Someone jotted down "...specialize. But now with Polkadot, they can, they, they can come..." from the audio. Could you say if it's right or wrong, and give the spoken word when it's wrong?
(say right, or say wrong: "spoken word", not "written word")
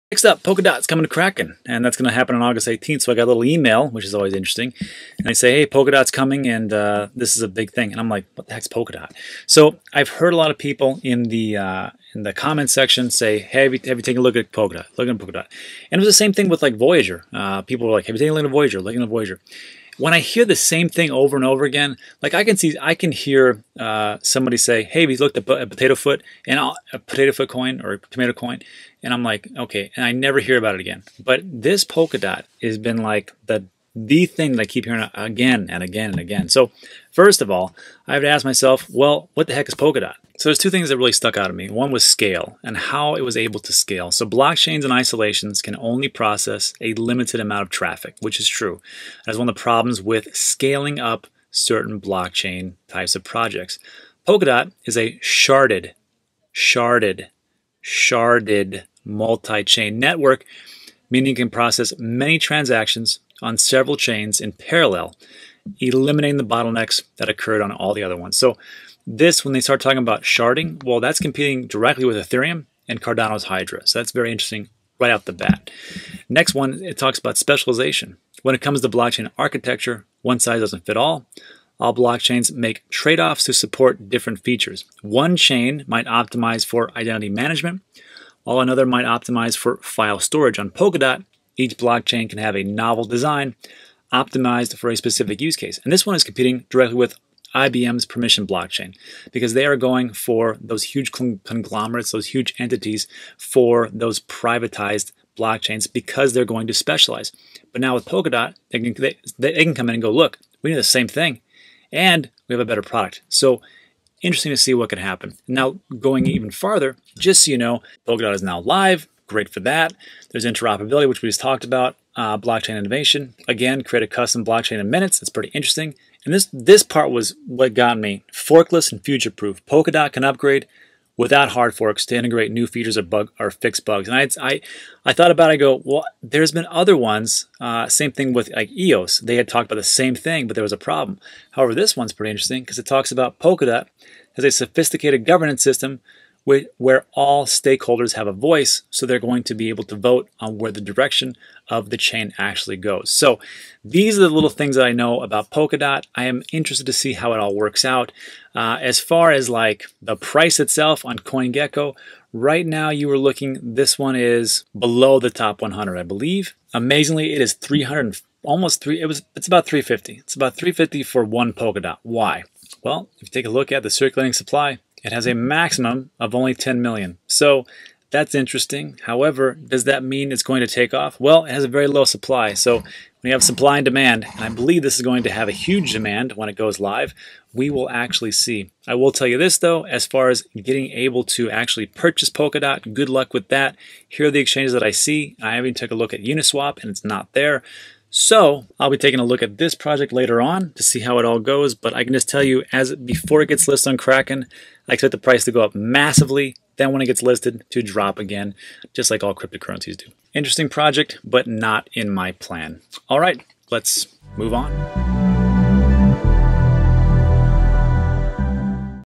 right.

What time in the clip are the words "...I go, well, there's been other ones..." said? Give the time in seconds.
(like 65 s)
135 s.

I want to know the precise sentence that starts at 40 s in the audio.
So there's two things that really stuck out to me.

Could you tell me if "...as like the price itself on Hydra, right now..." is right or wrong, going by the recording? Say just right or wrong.
wrong.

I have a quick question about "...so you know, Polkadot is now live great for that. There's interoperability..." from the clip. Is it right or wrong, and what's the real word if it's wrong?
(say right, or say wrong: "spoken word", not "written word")
right.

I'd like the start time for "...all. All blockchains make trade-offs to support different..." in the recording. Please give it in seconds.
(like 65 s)
80 s.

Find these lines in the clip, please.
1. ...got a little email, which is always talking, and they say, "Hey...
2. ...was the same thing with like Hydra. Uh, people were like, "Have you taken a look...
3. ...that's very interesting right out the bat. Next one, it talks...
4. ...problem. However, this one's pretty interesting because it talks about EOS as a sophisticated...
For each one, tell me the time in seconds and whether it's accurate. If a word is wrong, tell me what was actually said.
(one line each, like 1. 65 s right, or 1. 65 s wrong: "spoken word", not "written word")
1. 3 s wrong: "interesting", not "talking"
2. 16 s wrong: "Voyager", not "Hydra"
3. 73 s right
4. 140 s wrong: "Polkadot", not "EOS".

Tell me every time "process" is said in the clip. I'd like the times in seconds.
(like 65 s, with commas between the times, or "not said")
46 s, 61 s.